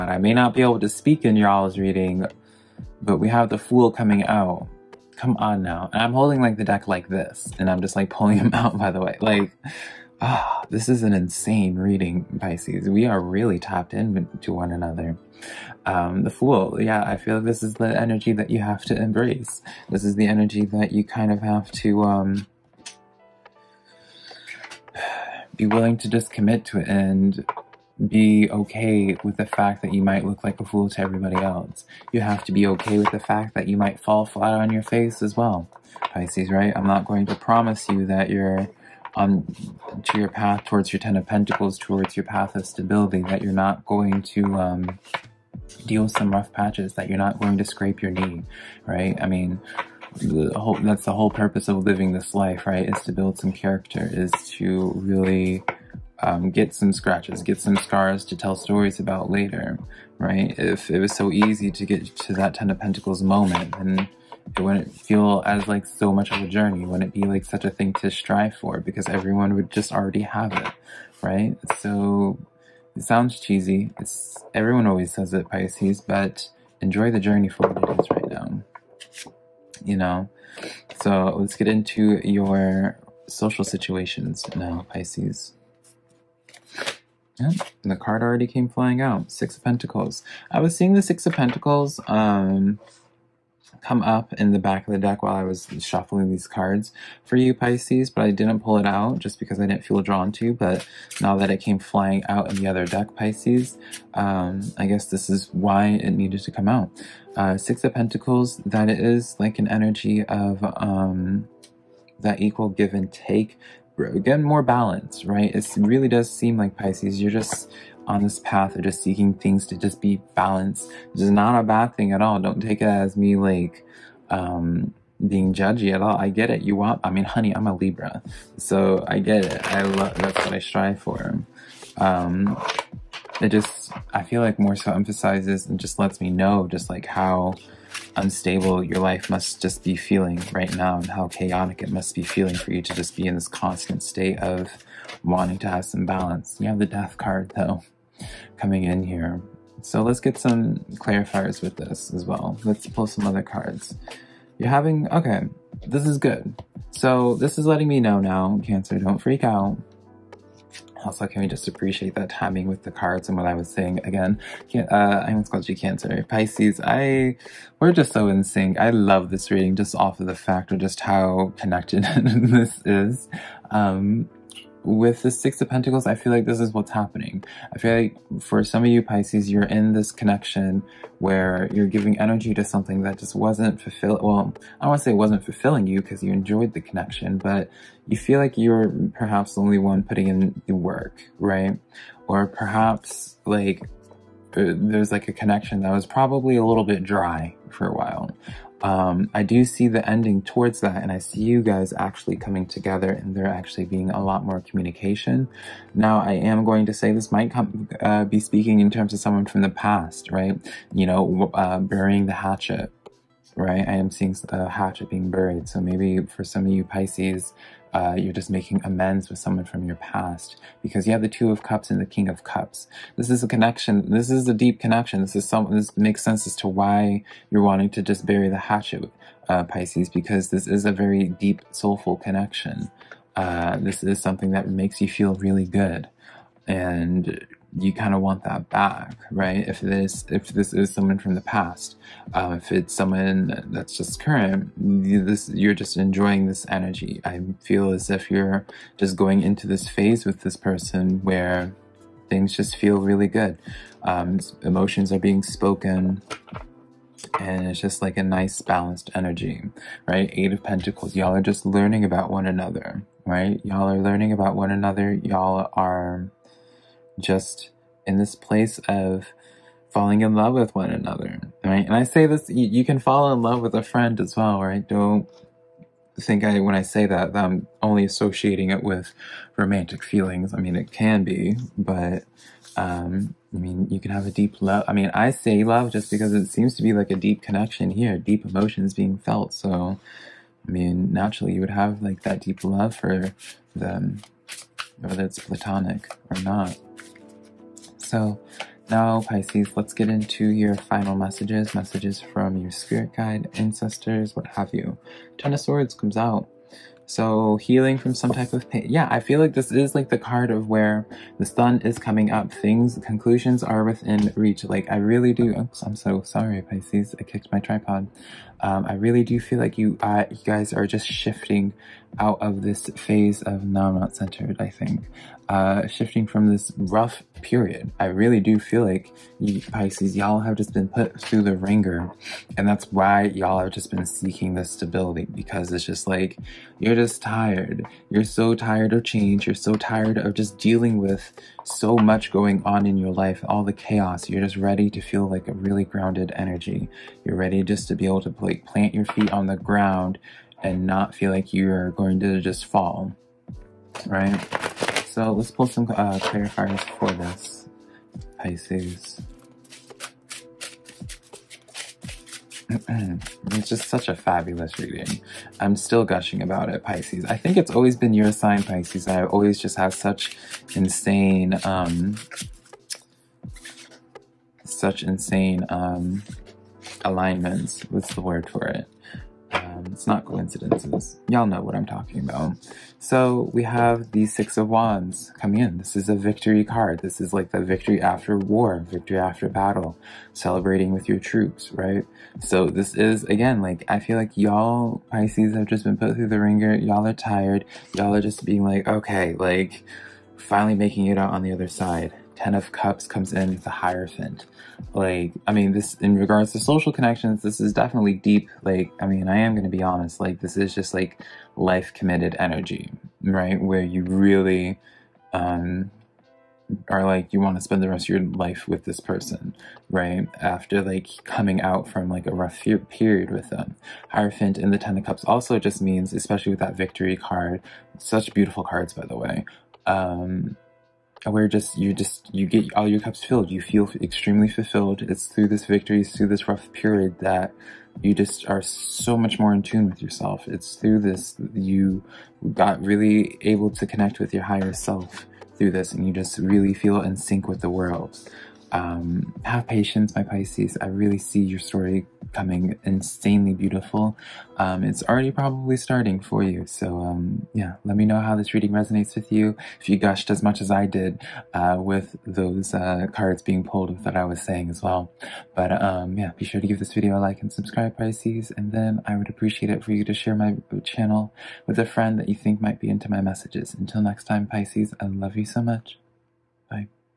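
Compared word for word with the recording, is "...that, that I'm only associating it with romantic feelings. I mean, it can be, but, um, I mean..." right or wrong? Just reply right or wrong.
right.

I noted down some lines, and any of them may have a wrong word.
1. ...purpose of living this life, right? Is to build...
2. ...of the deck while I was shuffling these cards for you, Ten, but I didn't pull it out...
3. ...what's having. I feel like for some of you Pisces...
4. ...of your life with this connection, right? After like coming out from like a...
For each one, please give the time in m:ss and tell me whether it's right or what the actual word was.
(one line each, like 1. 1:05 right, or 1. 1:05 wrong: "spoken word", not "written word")
1. 0:51 right
2. 1:34 wrong: "Pisces", not "Ten"
3. 2:56 wrong: "happening", not "having"
4. 6:58 wrong: "person", not "connection".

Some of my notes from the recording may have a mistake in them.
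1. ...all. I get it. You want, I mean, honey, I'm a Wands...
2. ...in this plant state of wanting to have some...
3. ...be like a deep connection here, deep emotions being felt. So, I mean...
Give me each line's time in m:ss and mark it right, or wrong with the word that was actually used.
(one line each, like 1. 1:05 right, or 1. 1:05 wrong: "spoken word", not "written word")
1. 2:06 wrong: "Libra", not "Wands"
2. 2:23 wrong: "constant", not "plant"
3. 4:46 right.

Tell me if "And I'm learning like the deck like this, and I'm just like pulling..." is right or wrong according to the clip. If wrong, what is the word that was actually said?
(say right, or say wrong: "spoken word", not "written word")
wrong: "holding", not "learning".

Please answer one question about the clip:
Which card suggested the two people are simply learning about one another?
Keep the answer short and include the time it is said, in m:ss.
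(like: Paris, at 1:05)
Eight of Pentacles, at 4:20.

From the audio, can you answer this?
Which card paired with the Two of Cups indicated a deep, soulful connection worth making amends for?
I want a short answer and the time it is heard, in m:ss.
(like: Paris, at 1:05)
King of Cups, at 3:42.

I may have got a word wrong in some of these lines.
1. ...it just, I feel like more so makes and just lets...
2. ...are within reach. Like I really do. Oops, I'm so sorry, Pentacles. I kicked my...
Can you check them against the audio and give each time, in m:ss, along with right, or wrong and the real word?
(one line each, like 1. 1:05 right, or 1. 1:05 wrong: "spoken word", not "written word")
1. 2:13 wrong: "emphasizes", not "makes"
2. 5:13 wrong: "Pisces", not "Pentacles".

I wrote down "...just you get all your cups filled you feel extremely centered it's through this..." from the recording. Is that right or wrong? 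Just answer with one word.
wrong.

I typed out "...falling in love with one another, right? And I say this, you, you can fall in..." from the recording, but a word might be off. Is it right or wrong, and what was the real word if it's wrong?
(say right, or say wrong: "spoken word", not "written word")
right.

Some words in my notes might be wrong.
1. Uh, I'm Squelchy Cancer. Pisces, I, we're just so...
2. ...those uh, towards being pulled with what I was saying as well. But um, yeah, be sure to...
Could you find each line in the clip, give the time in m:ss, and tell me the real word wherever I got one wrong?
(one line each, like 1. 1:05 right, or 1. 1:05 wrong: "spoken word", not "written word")
1. 2:44 right
2. 7:42 wrong: "cards", not "towards".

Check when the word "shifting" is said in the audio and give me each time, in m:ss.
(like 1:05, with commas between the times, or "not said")
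5:21, 5:25.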